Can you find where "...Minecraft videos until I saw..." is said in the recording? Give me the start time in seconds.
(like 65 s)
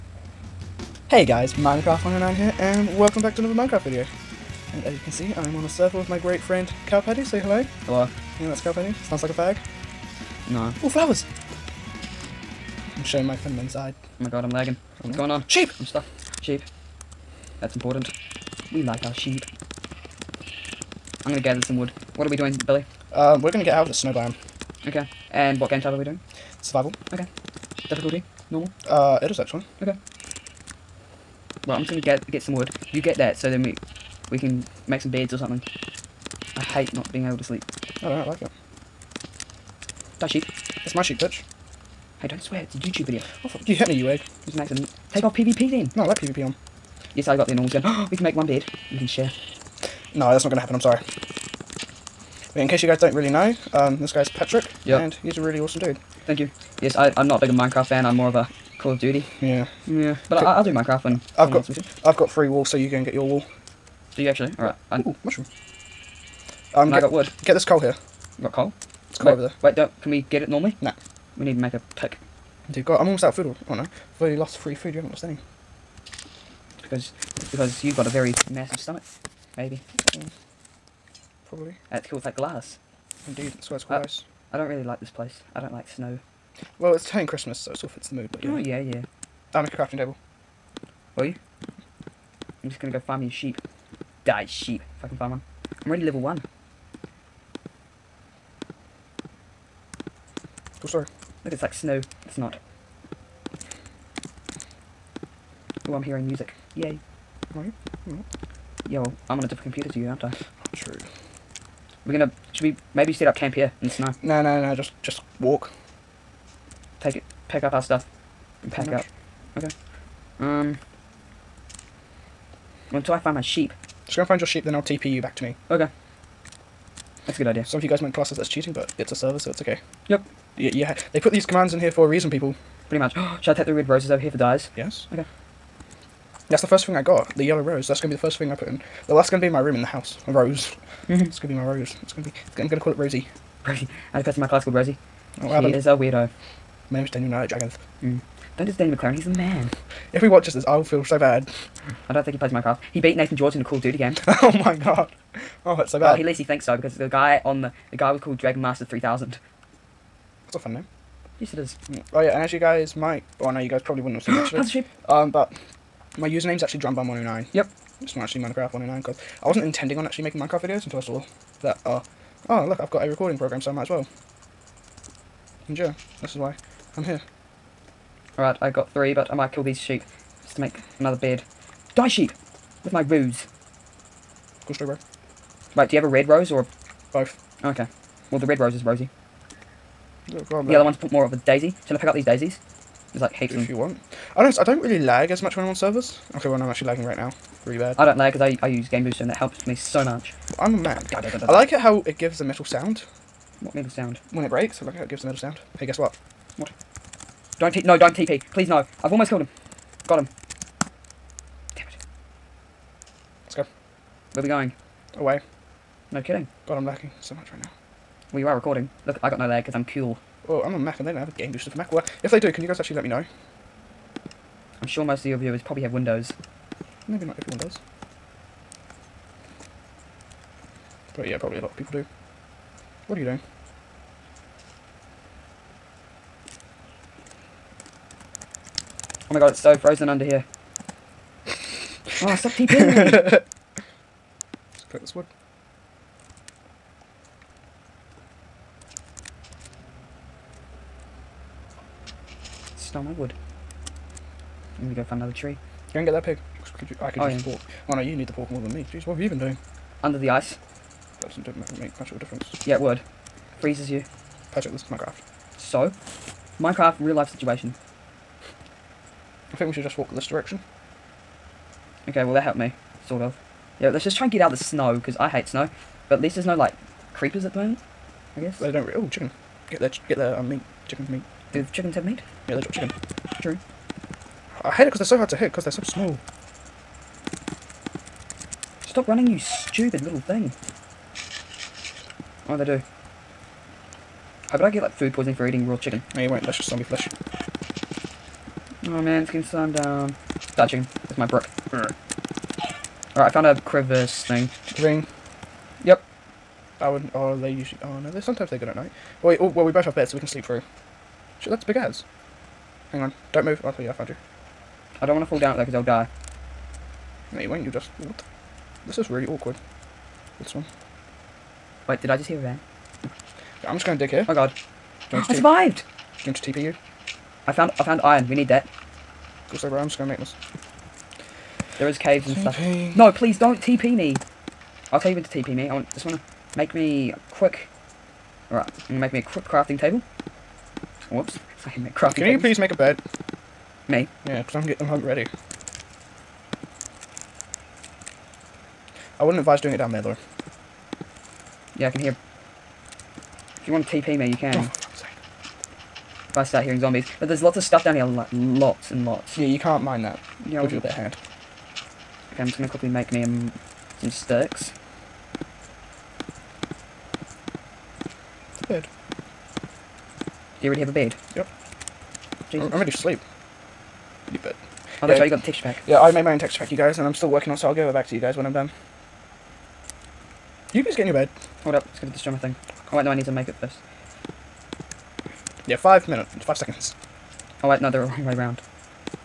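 170 s.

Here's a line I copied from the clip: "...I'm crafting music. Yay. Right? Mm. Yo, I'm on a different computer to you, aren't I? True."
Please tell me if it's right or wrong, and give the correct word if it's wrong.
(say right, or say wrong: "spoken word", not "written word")
wrong: "hearing", not "crafting".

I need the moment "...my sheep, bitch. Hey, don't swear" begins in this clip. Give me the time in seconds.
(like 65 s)
40 s.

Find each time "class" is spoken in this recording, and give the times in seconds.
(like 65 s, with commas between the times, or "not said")
128 s, 144 s.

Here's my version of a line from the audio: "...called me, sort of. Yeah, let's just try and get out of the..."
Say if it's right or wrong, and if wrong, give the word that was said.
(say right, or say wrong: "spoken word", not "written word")
wrong: "helped", not "called".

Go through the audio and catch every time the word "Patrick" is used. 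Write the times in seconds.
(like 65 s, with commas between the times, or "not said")
54 s, 264 s.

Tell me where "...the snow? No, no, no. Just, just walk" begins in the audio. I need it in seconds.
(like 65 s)
113 s.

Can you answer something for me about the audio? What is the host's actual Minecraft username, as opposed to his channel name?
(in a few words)
drumbum109.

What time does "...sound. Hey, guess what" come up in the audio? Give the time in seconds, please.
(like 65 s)
205 s.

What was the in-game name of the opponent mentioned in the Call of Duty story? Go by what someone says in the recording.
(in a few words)
Dragon Master 3000.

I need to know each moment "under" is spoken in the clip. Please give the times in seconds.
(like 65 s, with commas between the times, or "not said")
240 s, 260 s.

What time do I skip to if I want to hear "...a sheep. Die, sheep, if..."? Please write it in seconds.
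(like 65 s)
93 s.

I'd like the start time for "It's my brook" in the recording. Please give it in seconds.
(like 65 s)
301 s.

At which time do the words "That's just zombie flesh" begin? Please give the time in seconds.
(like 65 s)
296 s.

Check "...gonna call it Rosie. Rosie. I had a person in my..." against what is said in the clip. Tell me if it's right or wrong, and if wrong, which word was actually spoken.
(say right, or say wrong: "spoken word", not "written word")
right.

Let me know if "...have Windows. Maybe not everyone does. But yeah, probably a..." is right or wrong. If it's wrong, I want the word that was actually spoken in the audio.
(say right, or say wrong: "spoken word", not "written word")
right.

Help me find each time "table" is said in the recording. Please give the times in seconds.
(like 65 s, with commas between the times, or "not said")
89 s, 339 s.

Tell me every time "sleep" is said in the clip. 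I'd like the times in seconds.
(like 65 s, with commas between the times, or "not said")
37 s, 310 s, 372 s.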